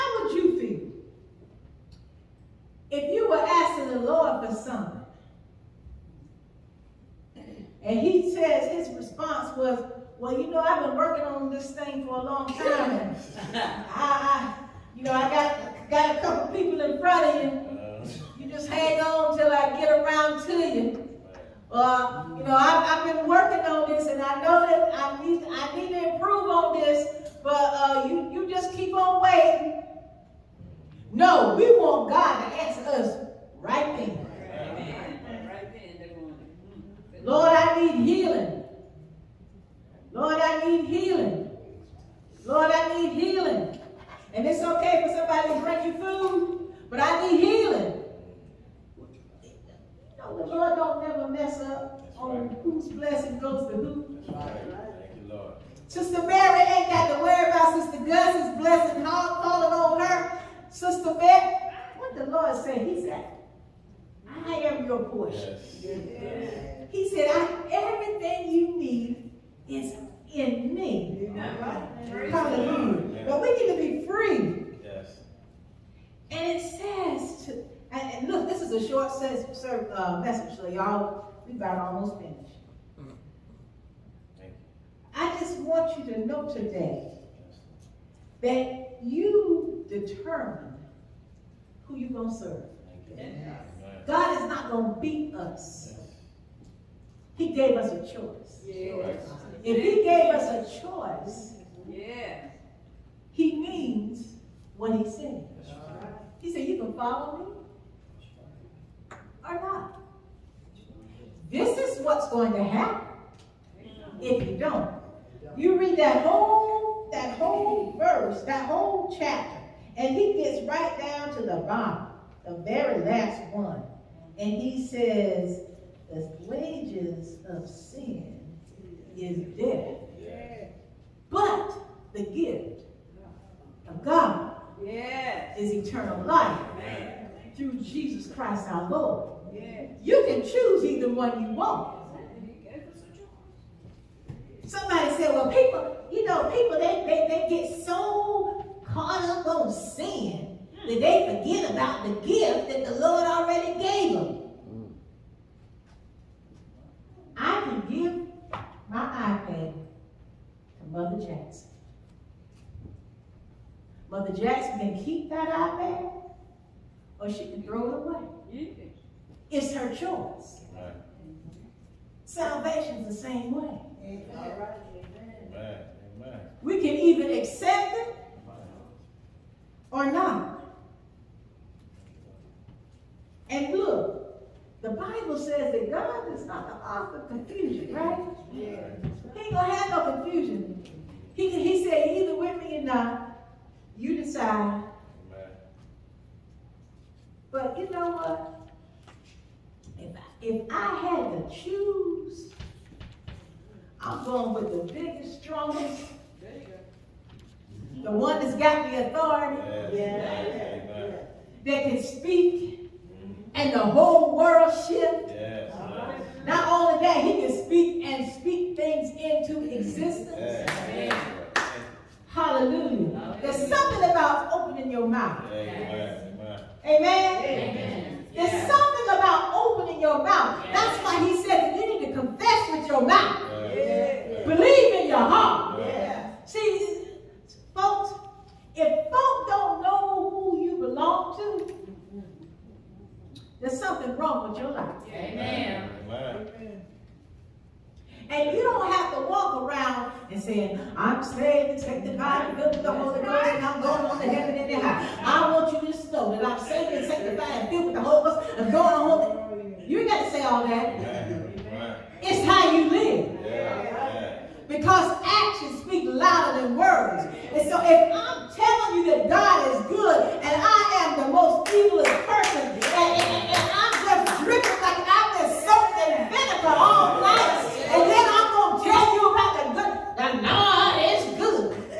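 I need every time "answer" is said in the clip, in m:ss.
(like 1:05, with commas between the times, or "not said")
0:32.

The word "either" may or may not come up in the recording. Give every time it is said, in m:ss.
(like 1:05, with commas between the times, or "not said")
2:20, 2:56, 3:12.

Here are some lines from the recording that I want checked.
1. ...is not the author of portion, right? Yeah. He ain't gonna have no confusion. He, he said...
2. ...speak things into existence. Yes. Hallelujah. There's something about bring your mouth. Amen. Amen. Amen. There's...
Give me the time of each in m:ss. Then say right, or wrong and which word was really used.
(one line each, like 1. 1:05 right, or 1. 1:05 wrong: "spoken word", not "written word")
1. 3:06 wrong: "confusion", not "portion"
2. 3:38 wrong: "opening", not "bring".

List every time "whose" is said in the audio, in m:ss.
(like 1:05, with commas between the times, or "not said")
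0:52.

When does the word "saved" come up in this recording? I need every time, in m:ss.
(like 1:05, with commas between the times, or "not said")
4:11, 4:16.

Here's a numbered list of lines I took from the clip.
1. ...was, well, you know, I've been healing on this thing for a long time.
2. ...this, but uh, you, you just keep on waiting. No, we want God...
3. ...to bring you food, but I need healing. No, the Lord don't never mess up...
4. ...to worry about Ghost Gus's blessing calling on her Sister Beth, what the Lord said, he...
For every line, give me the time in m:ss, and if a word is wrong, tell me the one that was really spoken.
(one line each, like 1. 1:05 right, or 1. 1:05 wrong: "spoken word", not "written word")
1. 0:09 wrong: "working", not "healing"
2. 0:26 right
3. 0:45 right
4. 0:57 wrong: "Sister", not "Ghost".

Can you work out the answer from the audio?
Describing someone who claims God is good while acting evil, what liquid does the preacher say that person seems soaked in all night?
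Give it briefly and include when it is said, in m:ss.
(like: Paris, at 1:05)
vinegar, at 4:36.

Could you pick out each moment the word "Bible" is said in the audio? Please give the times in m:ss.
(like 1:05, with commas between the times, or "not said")
3:04.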